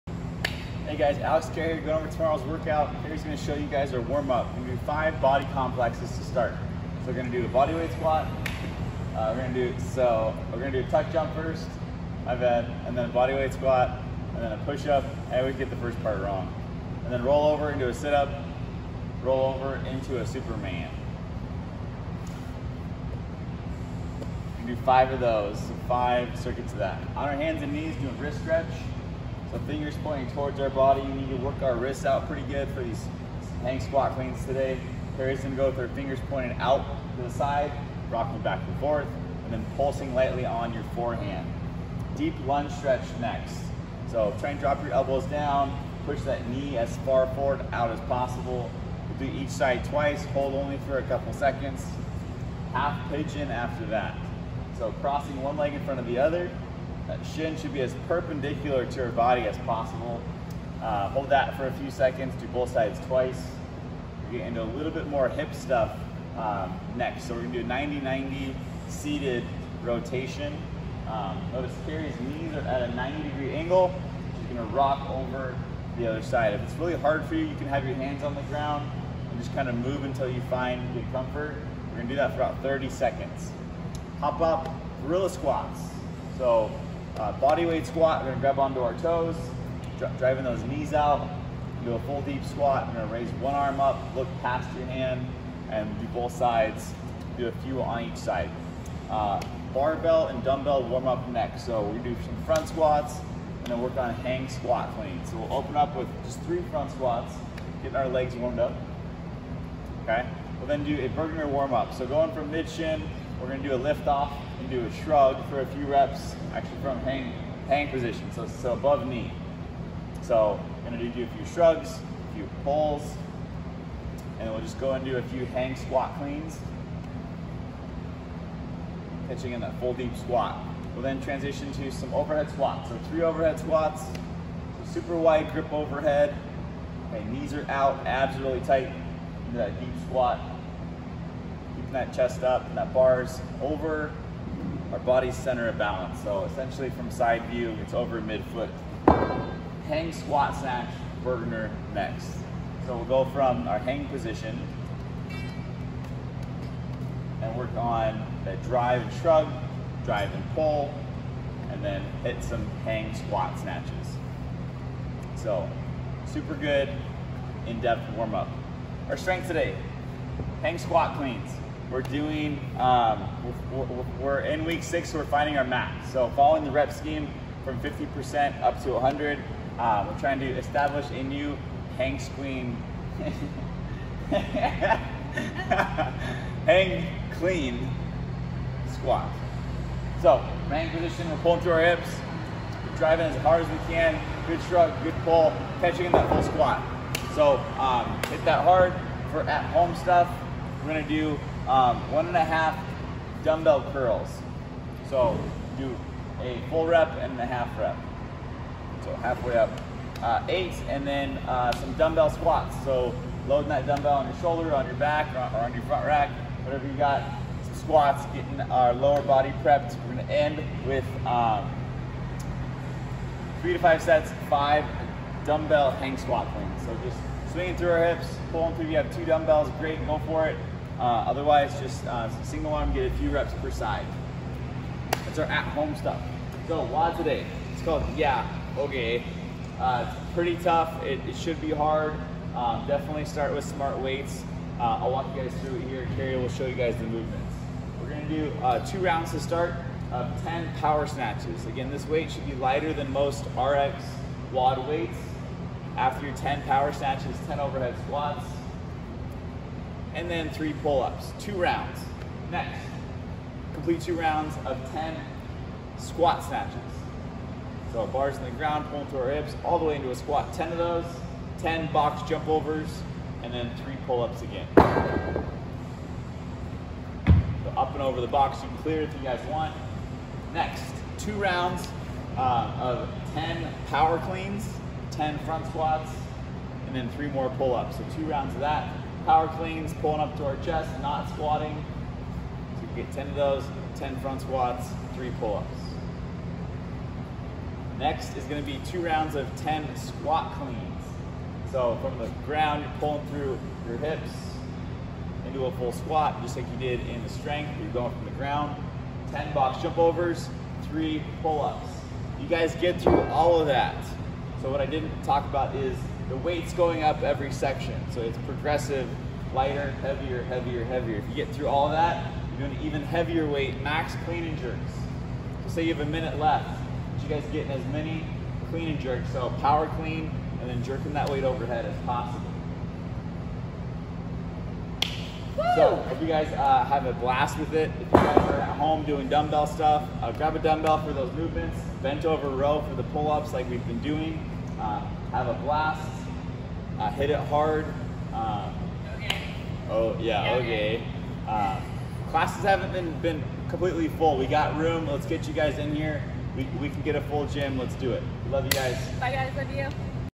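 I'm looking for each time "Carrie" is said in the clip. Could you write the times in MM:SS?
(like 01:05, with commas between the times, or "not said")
00:03, 00:35, 01:11, 04:06.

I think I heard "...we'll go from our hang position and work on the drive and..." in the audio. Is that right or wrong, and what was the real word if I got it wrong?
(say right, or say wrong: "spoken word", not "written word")
right.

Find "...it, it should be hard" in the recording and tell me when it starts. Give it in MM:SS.
04:01.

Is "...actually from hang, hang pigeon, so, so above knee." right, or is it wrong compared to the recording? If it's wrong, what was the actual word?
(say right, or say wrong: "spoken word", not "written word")
wrong: "position", not "pigeon".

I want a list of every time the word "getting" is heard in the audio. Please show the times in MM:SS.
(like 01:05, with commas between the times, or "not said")
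01:04, 01:47, 03:38, 05:27.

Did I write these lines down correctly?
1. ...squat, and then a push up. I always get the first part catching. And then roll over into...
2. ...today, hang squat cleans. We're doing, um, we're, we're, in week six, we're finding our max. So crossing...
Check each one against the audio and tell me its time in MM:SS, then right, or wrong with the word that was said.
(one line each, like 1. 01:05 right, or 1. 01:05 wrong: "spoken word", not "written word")
1. 00:13 wrong: "wrong", not "catching"
2. 02:49 wrong: "following", not "crossing".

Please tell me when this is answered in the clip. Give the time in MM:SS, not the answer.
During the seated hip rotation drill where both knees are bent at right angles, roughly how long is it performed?
01:22.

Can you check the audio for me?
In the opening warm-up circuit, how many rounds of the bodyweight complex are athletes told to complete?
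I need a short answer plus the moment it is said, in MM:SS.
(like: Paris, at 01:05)
5, at 00:25.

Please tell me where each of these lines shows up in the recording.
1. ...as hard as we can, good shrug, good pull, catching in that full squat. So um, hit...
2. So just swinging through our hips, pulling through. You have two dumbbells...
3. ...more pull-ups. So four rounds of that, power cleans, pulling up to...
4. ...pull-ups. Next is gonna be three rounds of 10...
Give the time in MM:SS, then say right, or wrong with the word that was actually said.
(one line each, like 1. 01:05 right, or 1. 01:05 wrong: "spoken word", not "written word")
1. 03:13 right
2. 03:46 right
3. 04:47 wrong: "two", not "four"
4. 04:55 wrong: "two", not "three".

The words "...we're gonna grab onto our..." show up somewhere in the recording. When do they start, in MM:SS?
01:28.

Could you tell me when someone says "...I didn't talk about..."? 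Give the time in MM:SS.
05:14.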